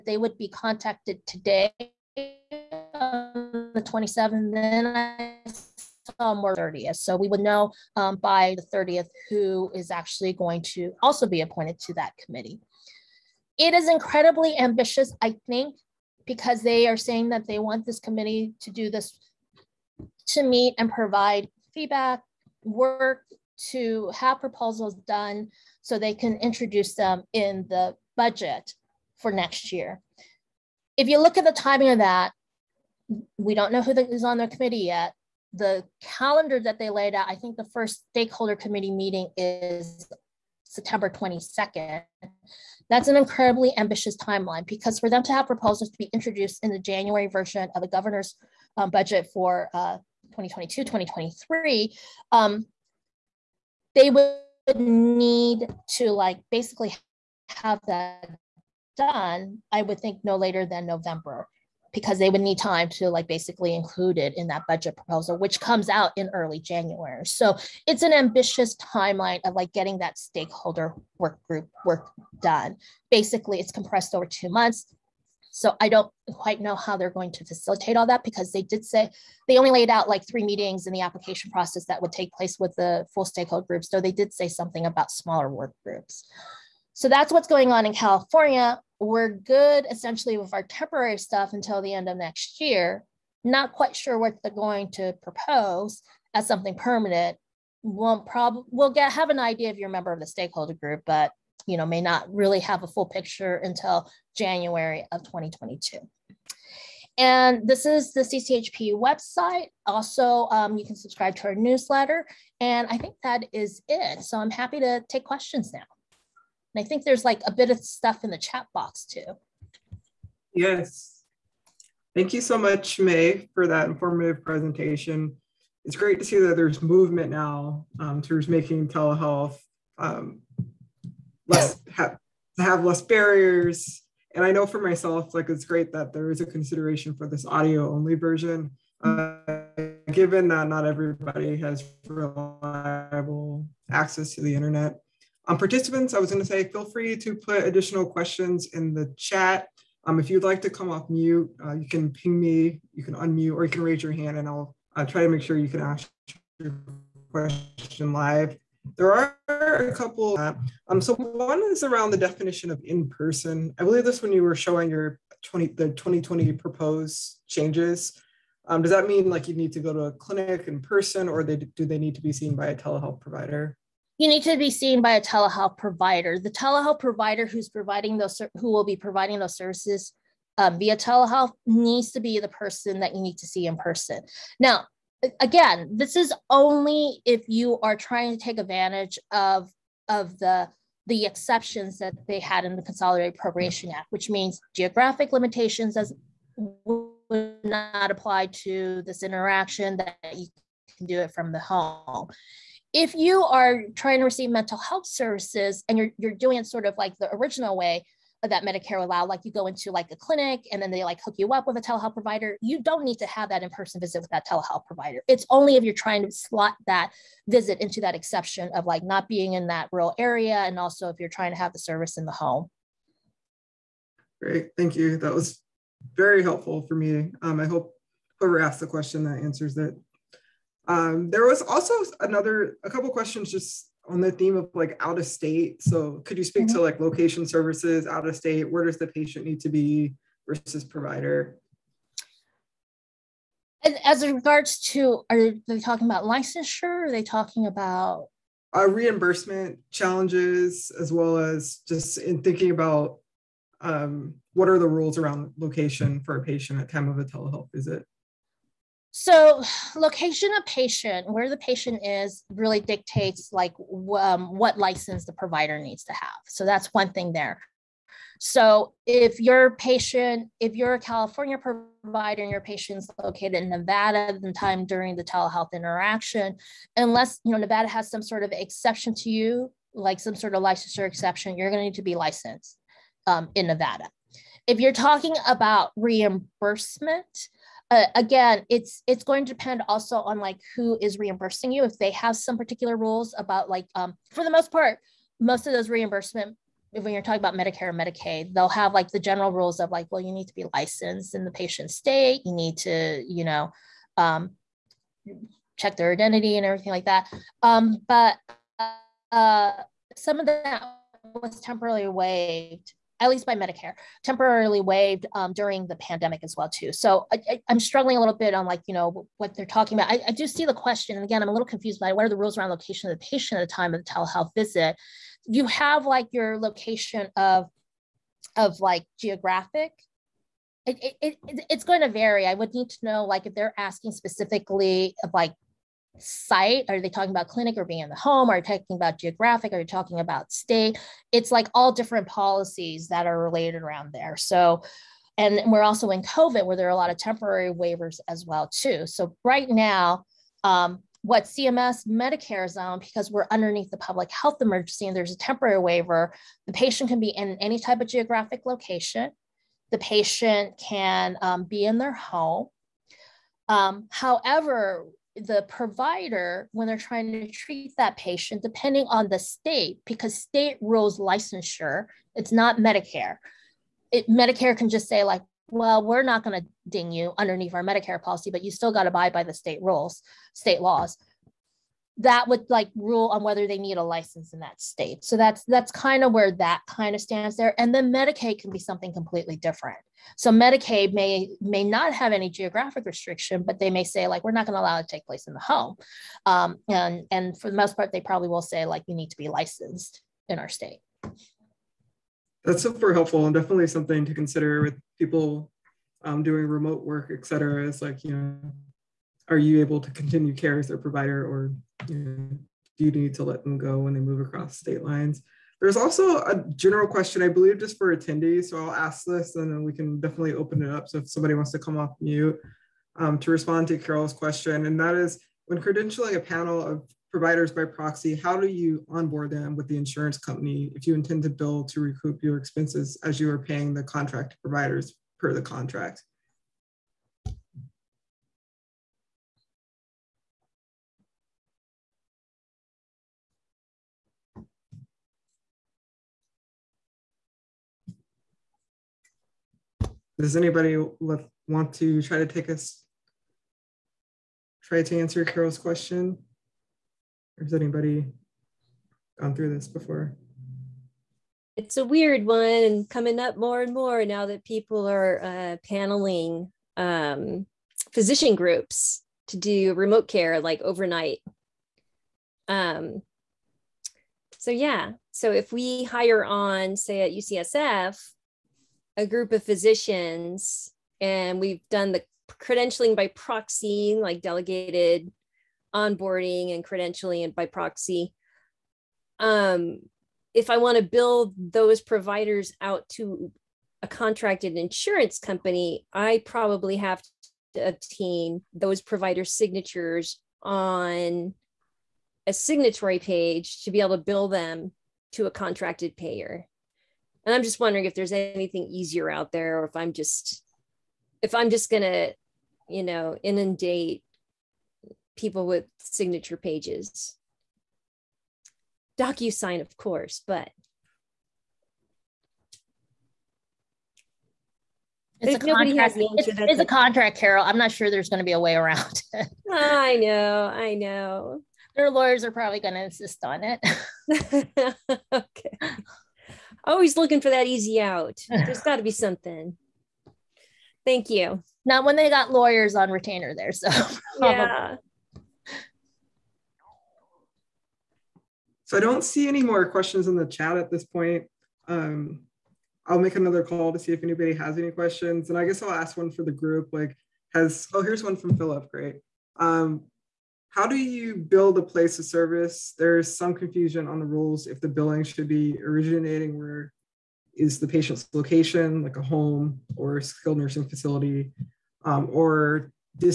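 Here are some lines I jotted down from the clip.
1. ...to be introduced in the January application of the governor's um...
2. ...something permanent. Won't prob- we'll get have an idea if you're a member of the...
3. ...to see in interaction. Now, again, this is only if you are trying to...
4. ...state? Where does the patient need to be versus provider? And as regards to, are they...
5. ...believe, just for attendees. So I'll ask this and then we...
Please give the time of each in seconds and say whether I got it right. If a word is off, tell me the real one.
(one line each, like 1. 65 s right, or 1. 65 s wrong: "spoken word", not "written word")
1. 45 s wrong: "version", not "application"
2. 96 s right
3. 183 s wrong: "person", not "interaction"
4. 238 s right
5. 417 s right.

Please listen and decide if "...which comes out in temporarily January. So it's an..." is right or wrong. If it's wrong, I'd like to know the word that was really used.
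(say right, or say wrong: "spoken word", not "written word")
wrong: "early", not "temporarily".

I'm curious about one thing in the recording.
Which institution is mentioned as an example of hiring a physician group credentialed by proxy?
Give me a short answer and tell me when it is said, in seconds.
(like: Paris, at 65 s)
UCSF, at 477 s.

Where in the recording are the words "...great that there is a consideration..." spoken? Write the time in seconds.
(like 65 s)
135 s.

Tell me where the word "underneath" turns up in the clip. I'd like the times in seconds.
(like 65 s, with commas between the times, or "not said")
353 s, 377 s.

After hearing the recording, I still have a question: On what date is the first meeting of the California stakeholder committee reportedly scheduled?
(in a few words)
September 22nd.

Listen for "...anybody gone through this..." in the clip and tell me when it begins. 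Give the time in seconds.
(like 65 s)
457 s.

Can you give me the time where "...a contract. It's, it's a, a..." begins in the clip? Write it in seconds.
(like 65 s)
525 s.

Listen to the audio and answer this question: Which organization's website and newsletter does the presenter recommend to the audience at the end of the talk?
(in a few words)
CCHP.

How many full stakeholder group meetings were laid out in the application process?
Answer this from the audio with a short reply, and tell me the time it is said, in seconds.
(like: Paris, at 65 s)
3, at 80 s.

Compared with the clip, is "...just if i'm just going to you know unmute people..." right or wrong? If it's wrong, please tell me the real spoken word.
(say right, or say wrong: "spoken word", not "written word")
wrong: "inundate", not "unmute".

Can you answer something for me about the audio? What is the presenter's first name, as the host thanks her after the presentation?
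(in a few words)
Mei.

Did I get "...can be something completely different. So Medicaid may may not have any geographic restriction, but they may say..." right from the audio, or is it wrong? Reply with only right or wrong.
right.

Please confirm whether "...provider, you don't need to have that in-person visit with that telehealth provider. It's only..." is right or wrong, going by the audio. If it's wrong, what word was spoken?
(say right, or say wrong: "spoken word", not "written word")
right.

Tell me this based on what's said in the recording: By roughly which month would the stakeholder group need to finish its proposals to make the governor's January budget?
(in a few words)
November.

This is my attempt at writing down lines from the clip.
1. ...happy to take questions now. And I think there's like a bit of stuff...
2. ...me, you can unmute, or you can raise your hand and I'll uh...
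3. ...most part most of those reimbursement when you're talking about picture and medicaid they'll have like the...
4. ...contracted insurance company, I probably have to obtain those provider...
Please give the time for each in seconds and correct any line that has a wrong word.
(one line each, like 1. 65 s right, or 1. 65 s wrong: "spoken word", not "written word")
1. 114 s right
2. 152 s right
3. 294 s wrong: "medicare", not "picture"
4. 494 s right.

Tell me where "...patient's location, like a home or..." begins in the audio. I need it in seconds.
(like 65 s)
567 s.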